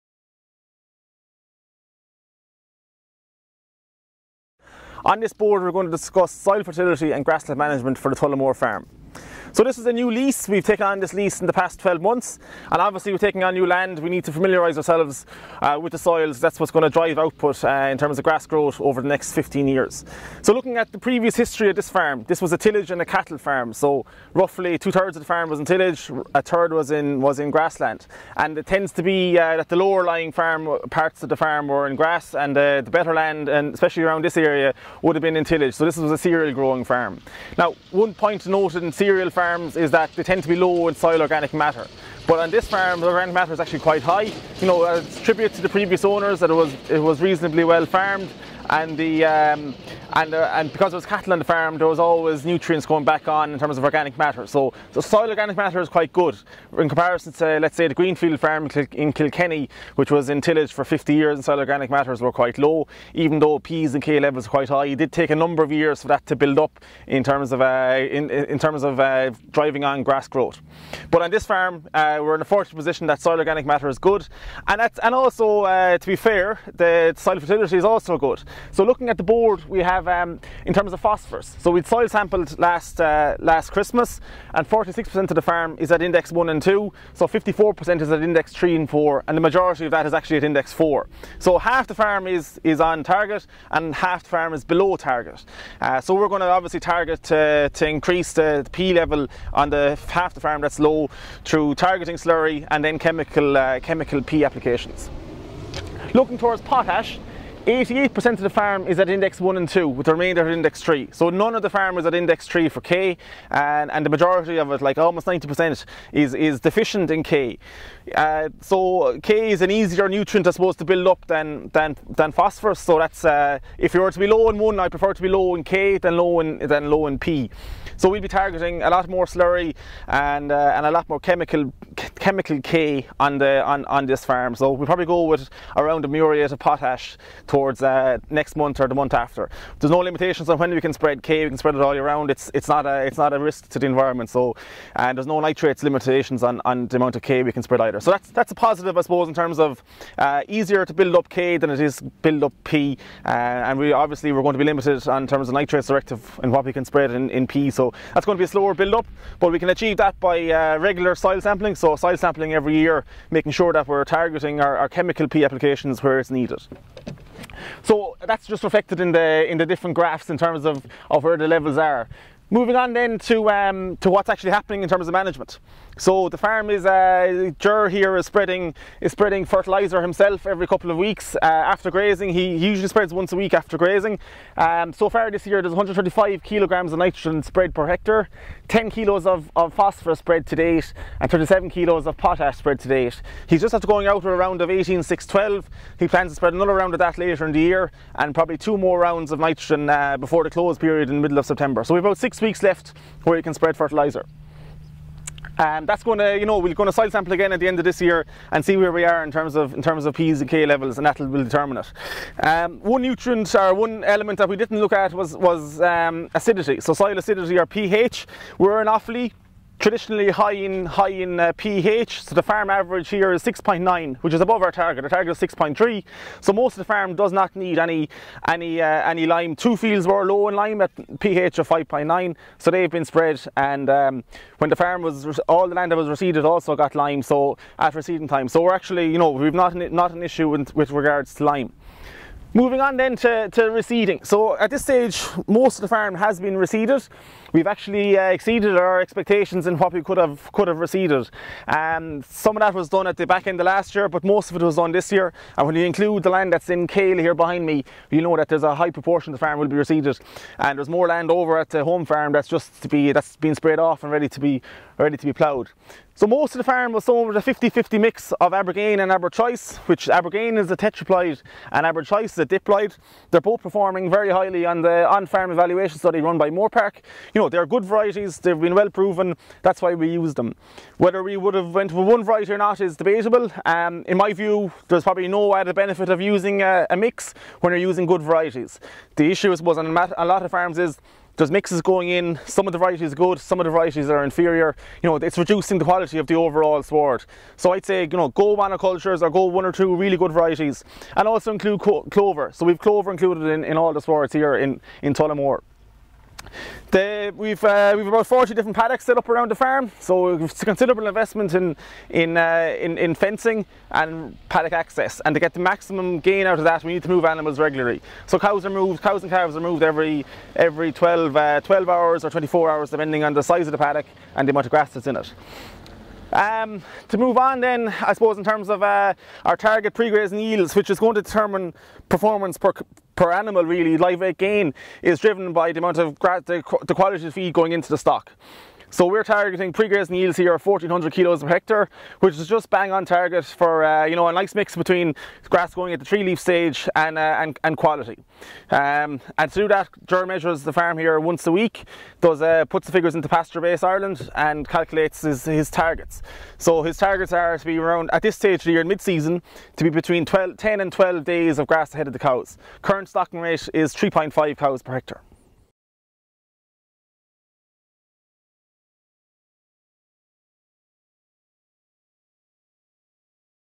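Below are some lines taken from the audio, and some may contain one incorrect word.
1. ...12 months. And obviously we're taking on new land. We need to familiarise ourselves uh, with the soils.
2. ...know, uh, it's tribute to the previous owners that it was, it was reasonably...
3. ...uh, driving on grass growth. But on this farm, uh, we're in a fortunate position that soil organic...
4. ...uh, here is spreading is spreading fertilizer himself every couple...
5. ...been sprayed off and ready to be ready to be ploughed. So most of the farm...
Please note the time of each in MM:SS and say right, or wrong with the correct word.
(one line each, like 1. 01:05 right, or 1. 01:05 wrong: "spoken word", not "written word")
1. 00:11 right
2. 00:44 right
3. 01:08 right
4. 02:56 right
5. 04:23 right.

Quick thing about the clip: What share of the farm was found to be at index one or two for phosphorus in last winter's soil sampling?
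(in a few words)
46%.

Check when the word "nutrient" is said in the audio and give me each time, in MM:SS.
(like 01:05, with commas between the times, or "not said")
00:52, 02:00, 03:33.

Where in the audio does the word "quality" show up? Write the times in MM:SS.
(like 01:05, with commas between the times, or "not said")
04:55, 05:36, 05:47.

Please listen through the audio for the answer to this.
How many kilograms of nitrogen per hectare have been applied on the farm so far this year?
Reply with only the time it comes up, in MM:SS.
03:05.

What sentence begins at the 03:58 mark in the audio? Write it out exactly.
So we're actually, you know, we've not, not an issue with, with regards to lime.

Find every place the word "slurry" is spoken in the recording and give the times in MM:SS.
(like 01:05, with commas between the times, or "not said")
01:42, 02:09.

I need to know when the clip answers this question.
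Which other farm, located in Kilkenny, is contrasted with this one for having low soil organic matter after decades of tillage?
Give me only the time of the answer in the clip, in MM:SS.
00:57.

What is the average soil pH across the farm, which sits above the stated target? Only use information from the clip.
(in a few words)
6.9.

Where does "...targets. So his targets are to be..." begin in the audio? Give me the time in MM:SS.
05:55.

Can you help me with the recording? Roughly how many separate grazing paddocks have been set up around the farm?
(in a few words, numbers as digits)
40.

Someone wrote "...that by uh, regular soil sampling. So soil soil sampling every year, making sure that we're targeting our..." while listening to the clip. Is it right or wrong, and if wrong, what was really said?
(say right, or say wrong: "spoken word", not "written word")
right.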